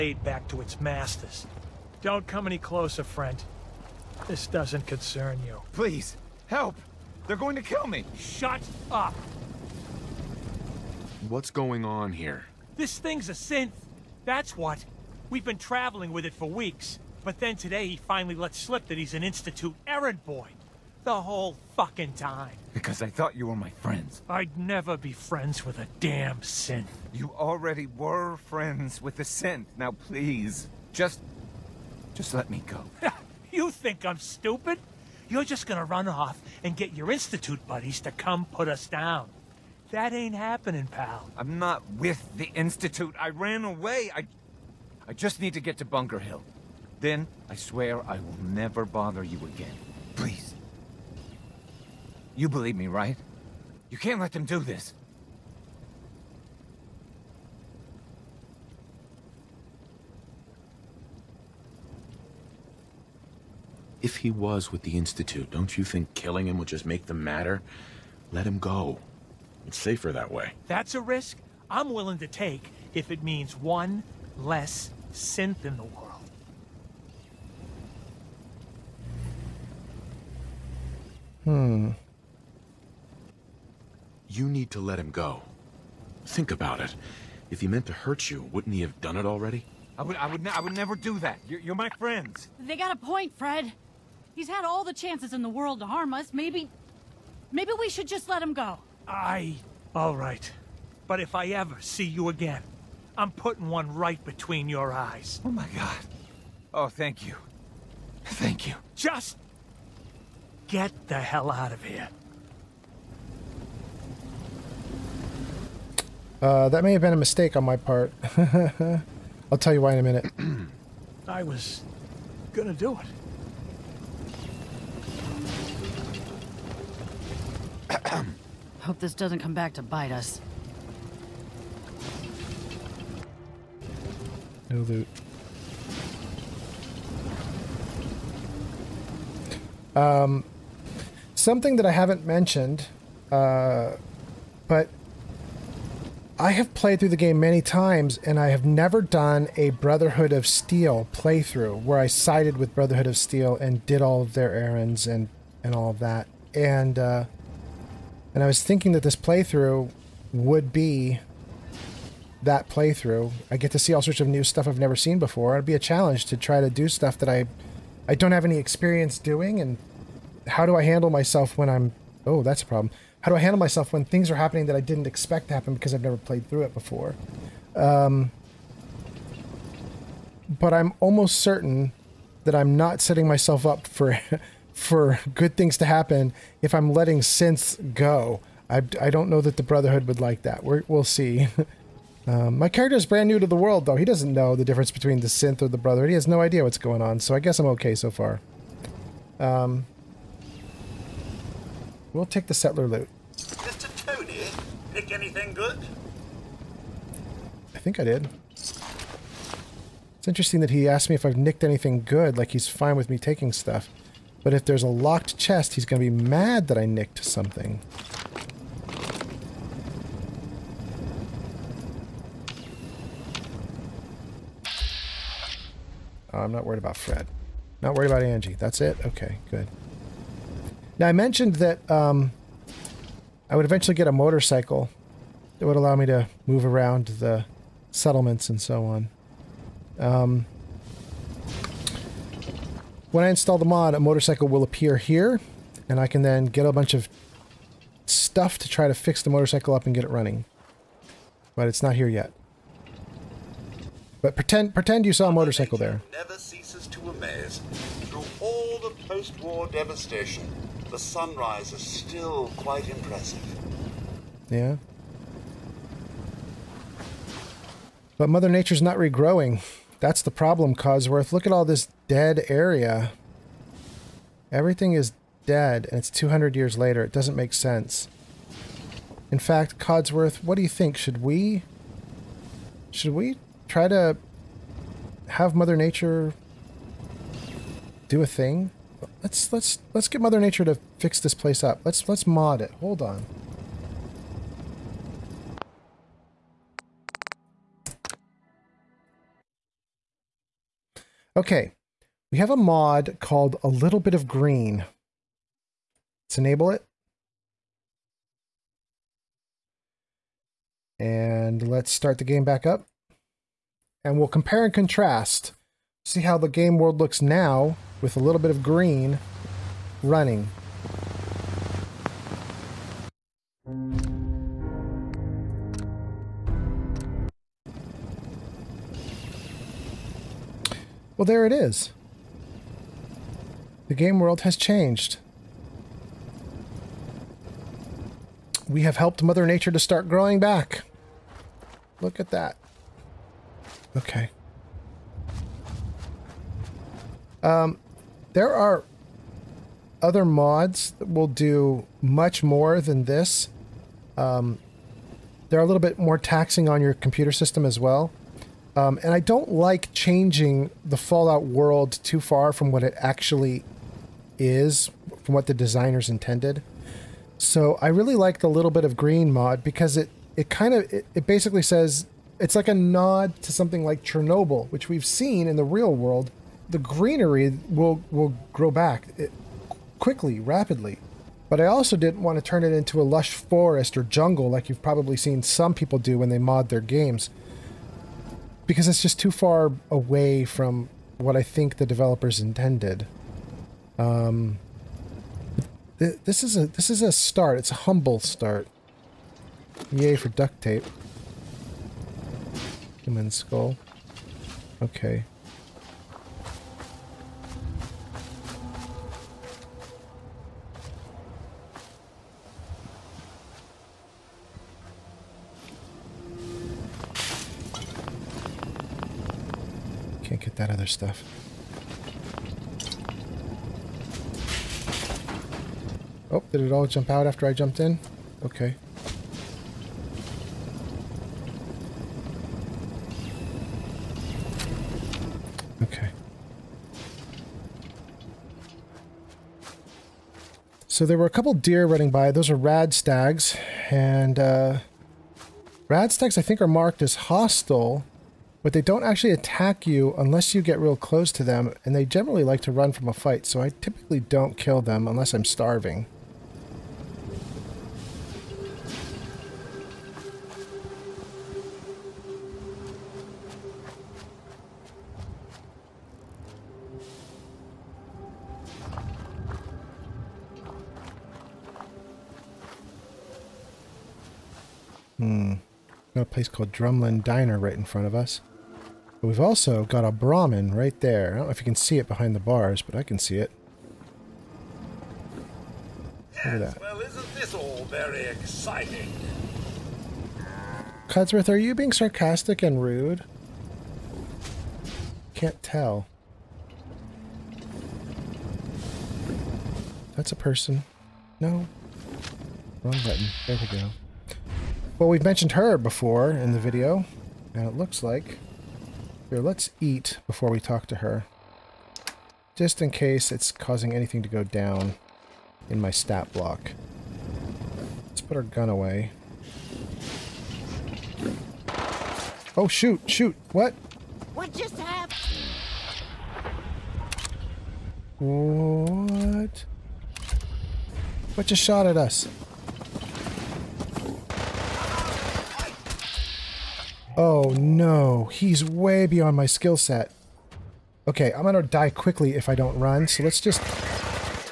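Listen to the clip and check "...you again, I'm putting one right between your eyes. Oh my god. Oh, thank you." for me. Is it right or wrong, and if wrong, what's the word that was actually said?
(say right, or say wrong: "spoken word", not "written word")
right.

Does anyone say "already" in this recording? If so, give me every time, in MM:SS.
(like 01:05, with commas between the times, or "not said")
00:27, 01:29.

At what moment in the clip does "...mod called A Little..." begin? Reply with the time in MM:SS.
05:02.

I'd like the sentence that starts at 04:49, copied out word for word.
Let's let's let's get Mother Nature to fix this place up.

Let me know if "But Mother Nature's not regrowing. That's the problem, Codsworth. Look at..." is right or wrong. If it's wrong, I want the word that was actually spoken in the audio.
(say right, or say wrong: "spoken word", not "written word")
right.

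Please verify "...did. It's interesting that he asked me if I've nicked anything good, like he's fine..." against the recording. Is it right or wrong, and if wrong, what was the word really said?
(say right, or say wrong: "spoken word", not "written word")
right.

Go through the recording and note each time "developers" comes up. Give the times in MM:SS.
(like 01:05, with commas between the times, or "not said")
06:31.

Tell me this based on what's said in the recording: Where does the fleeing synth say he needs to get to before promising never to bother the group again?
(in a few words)
Bunker Hill.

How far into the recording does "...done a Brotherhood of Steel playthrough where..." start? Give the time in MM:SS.
02:29.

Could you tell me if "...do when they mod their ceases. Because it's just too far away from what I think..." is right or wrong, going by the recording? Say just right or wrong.
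wrong.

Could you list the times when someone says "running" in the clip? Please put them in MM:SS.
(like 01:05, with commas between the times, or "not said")
04:10, 05:20, 07:21.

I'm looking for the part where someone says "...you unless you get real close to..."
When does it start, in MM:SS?
07:29.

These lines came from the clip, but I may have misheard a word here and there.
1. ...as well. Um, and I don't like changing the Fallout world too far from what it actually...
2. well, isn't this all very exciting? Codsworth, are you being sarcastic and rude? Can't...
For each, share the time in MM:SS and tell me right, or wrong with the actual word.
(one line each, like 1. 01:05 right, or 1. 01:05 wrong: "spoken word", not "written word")
1. 05:57 right
2. 08:06 right.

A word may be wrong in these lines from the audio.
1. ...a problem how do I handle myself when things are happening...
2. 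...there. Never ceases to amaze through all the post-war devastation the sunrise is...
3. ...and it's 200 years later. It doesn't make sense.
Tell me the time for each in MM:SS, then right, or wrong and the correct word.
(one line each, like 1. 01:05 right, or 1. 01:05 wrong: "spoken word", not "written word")
1. 02:52 right
2. 04:15 right
3. 04:35 right.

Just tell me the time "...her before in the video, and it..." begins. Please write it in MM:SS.
08:25.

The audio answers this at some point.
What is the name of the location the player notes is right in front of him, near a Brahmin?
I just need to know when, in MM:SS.
07:56.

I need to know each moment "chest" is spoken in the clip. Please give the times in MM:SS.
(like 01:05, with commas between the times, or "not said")
03:35.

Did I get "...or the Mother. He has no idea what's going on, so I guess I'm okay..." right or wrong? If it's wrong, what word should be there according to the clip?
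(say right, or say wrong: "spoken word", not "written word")
wrong: "Brotherhood", not "Mother".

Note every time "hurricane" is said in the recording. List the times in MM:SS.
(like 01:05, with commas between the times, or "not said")
not said.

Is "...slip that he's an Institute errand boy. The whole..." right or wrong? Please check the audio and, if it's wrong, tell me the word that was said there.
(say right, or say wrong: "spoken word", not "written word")
right.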